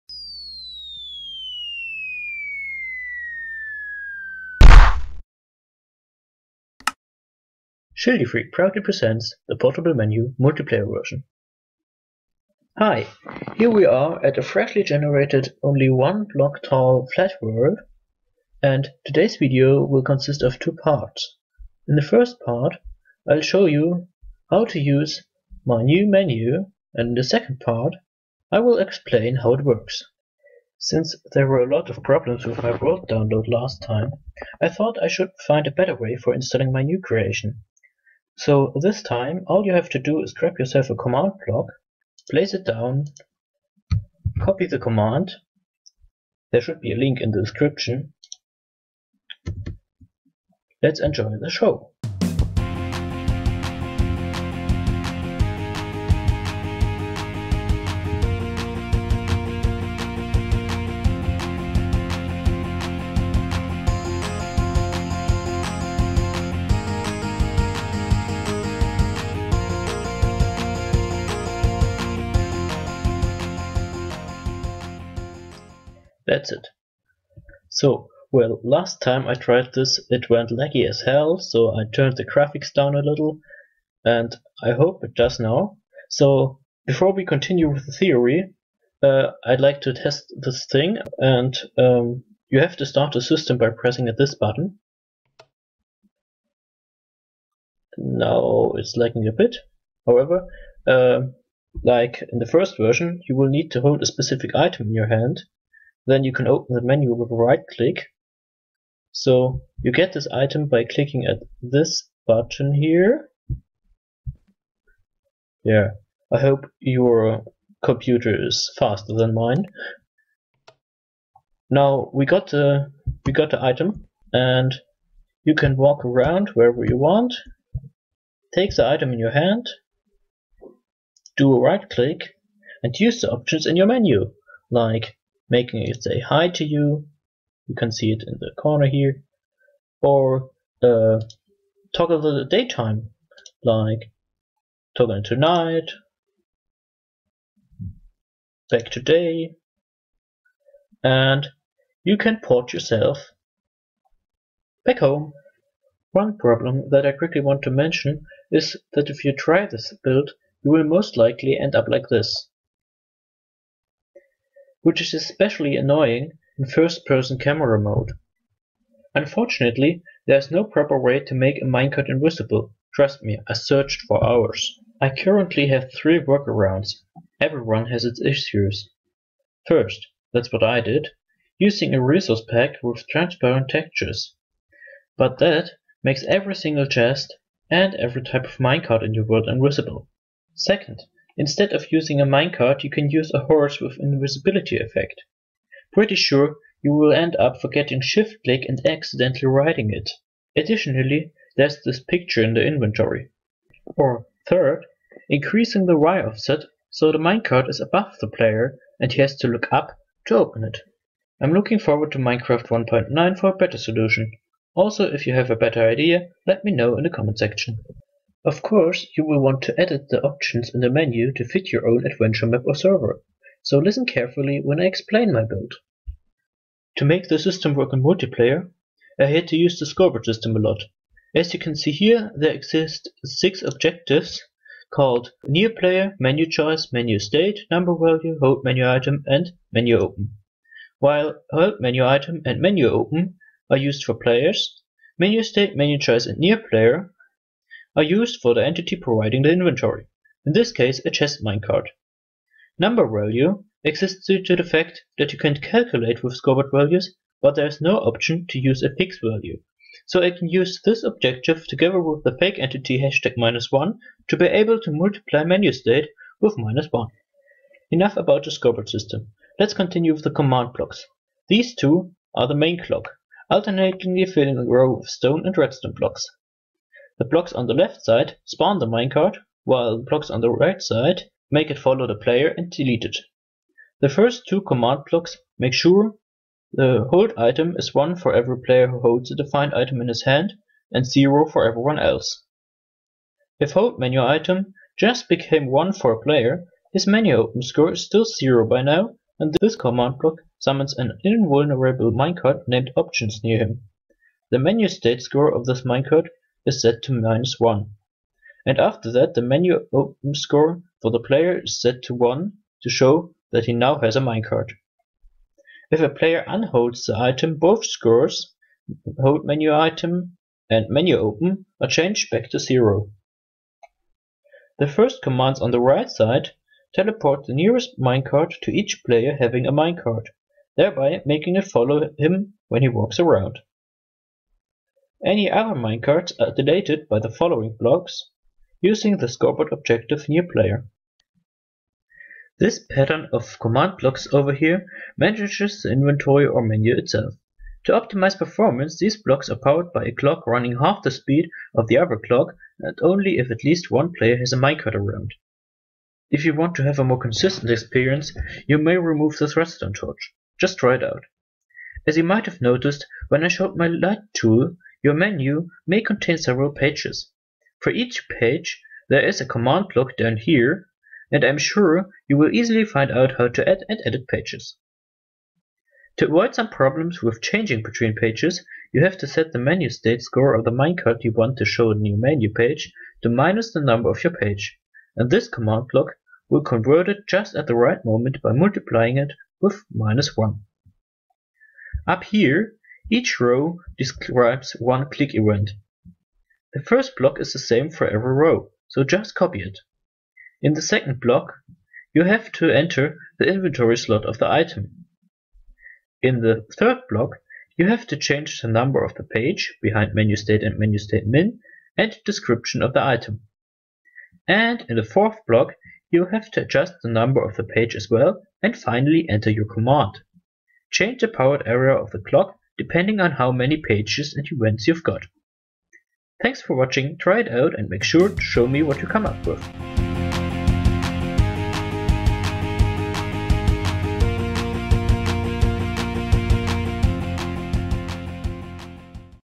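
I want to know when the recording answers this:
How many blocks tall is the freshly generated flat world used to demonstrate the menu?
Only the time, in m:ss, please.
0:15.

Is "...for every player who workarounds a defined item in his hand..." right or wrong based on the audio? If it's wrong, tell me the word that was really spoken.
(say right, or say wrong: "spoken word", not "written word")
wrong: "holds", not "workarounds".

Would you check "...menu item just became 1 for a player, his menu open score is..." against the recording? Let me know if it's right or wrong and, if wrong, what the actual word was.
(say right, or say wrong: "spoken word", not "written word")
right.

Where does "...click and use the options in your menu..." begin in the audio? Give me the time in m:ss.
2:11.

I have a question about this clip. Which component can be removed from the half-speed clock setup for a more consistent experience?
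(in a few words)
redstone torch.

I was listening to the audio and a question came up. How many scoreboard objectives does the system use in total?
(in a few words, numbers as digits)
6.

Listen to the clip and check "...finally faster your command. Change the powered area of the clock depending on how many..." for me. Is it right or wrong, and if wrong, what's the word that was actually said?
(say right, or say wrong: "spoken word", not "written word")
wrong: "enter", not "faster".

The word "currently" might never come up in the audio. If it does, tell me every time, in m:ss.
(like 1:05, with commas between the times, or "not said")
2:55.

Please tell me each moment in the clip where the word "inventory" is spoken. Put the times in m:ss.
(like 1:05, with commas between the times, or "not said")
3:22, 4:09, 5:45, 6:43.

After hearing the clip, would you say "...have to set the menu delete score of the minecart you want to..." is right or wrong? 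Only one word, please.
wrong.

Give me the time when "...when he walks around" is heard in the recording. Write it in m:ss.
5:32.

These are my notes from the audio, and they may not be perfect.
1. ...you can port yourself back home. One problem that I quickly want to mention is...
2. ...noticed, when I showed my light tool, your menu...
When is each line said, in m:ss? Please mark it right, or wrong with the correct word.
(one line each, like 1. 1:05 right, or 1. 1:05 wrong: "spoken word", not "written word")
1. 2:32 right
2. 6:02 right.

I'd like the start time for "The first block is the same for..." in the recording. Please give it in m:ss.
6:36.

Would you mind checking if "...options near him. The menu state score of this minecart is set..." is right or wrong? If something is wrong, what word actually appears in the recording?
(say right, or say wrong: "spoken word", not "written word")
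right.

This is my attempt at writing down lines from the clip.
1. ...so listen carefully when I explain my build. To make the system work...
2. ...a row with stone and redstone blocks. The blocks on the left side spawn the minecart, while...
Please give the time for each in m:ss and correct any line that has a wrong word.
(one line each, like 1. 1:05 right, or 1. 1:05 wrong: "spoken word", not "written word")
1. 3:43 right
2. 4:34 right.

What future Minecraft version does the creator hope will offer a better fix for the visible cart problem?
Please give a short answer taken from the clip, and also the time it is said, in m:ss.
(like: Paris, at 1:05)
1.9, at 3:32.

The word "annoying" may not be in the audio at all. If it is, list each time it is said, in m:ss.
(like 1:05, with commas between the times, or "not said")
2:45.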